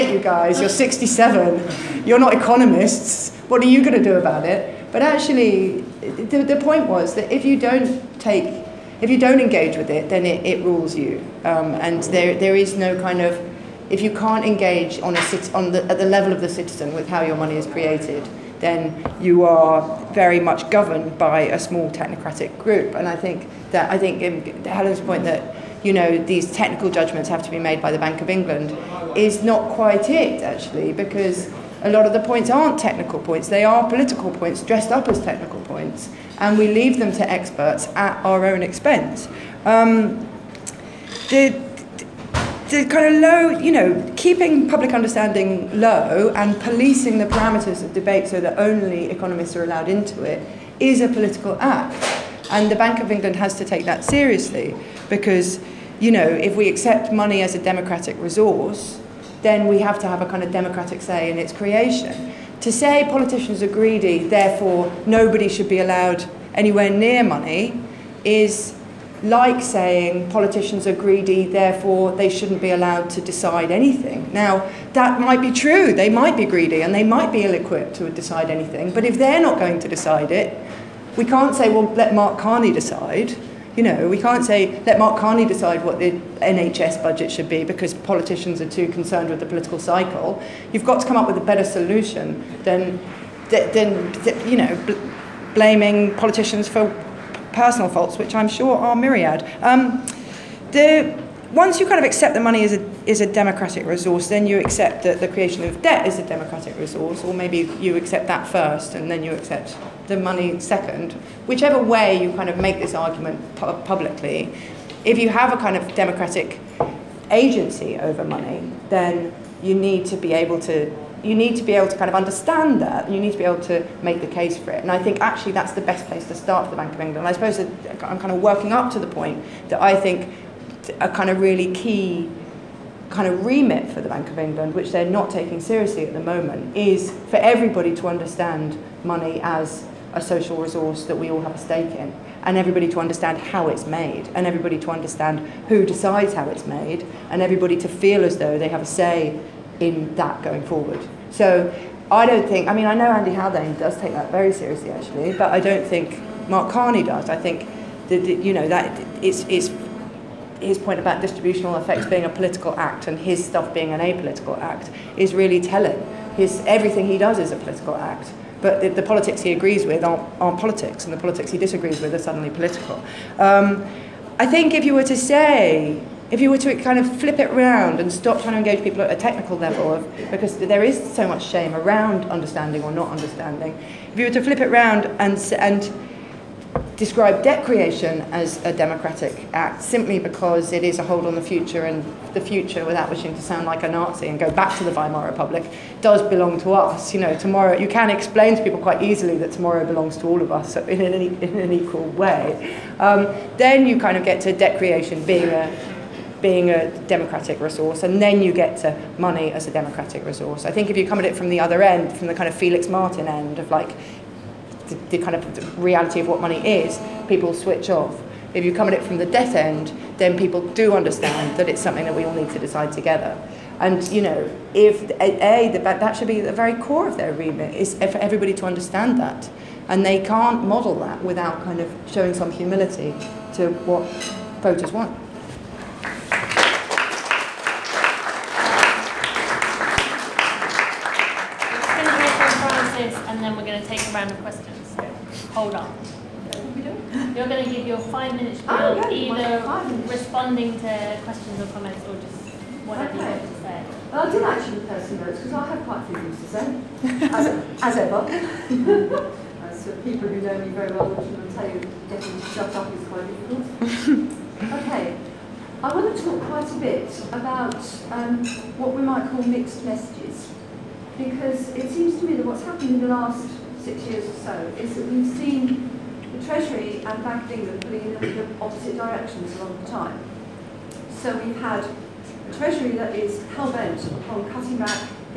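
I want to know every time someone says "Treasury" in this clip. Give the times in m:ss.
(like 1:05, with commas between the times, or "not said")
4:36, 4:42.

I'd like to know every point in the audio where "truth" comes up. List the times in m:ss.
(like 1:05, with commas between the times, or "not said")
not said.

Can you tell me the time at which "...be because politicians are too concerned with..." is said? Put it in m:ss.
1:27.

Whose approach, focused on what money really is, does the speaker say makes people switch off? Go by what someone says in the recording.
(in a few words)
Felix Martin.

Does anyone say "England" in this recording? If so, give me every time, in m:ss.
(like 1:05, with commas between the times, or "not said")
0:28, 0:53, 2:07, 2:14, 4:37.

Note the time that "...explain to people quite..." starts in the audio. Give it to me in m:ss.
3:18.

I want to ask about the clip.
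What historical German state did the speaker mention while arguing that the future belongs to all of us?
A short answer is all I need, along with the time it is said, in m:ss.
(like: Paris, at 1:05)
Weimar Republic, at 3:14.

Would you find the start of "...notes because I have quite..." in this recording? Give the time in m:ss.
4:15.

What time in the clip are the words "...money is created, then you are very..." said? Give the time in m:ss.
0:17.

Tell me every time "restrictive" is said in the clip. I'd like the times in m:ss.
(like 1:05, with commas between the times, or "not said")
not said.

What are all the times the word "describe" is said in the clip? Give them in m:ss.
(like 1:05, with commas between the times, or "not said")
3:06.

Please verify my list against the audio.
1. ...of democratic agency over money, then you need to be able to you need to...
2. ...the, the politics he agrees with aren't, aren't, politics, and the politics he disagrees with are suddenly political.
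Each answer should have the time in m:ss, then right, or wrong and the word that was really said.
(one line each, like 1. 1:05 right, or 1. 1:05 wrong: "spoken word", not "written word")
1. 1:55 right
2. 2:48 right.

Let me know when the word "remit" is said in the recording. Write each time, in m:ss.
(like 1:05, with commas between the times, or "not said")
2:13, 3:47.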